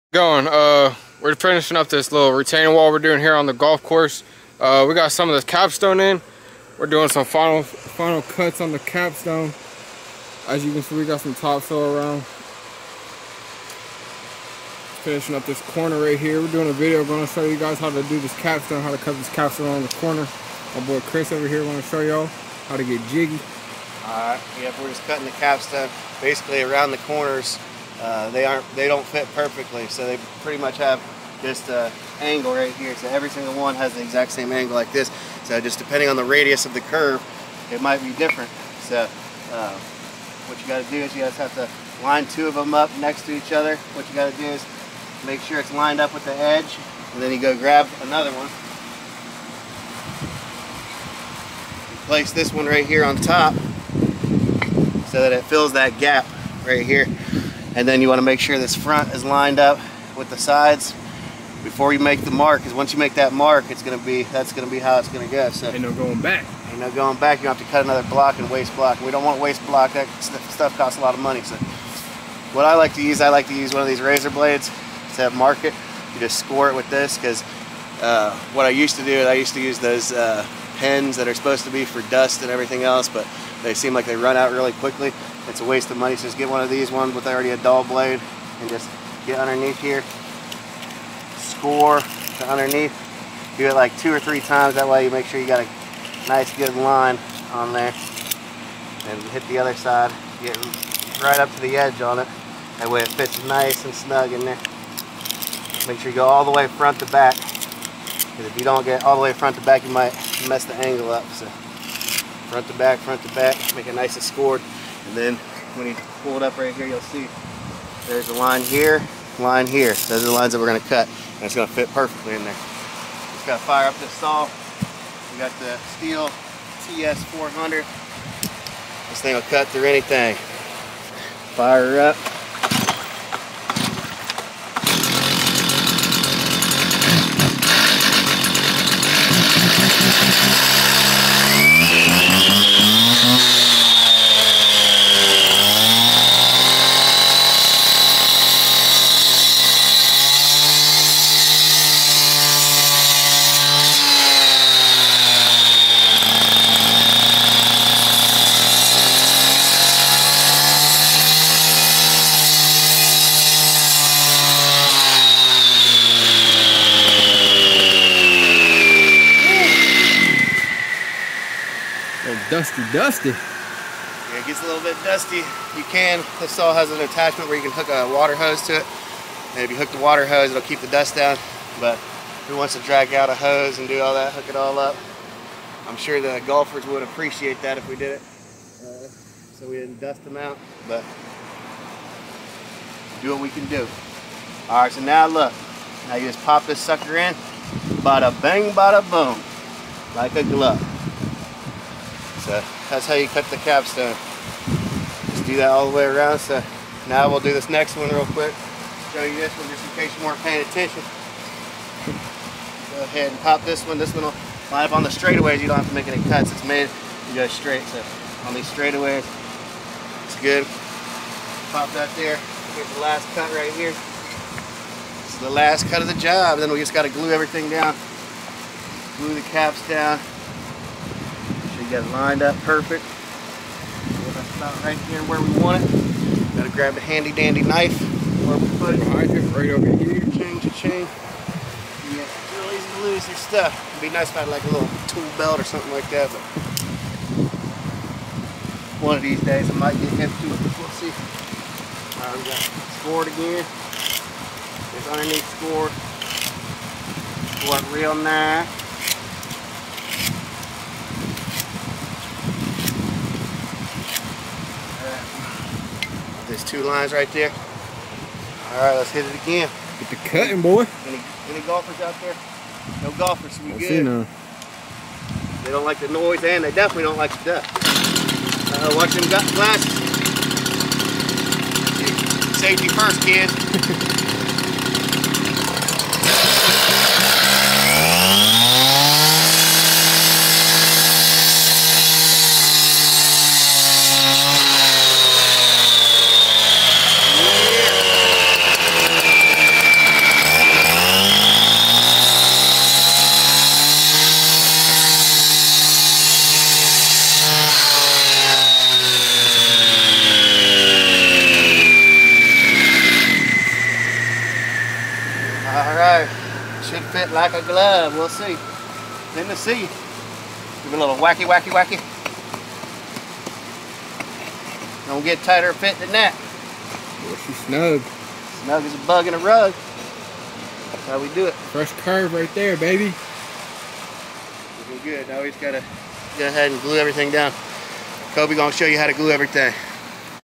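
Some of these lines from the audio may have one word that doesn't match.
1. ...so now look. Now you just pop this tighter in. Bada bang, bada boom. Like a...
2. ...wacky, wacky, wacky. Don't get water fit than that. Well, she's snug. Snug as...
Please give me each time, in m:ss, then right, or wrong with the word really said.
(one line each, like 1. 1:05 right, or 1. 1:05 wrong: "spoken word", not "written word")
1. 3:14 wrong: "sucker", not "tighter"
2. 5:21 wrong: "tighter", not "water".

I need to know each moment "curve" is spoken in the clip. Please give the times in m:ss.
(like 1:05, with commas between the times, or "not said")
0:36, 5:32.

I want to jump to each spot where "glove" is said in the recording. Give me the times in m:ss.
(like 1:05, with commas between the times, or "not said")
3:20, 5:17.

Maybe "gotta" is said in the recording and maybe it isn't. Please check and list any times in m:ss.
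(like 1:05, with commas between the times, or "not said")
2:03, 3:56, 5:35.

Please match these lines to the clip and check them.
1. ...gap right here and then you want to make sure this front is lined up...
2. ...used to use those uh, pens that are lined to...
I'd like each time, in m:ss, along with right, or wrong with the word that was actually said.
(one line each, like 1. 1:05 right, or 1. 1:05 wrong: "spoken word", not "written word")
1. 0:55 right
2. 1:19 wrong: "supposed", not "lined".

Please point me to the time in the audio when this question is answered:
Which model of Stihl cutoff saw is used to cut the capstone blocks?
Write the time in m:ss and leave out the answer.
2:06.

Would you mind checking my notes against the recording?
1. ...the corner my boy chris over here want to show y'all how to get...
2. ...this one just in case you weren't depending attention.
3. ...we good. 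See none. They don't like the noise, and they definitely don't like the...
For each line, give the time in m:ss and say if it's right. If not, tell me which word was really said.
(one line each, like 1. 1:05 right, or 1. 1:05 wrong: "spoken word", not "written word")
1. 0:19 right
2. 3:29 wrong: "paying", not "depending"
3. 4:33 right.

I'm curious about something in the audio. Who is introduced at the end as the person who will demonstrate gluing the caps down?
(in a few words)
Kobe.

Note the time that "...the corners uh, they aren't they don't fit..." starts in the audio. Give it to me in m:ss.
0:26.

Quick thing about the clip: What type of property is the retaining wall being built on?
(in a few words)
golf course.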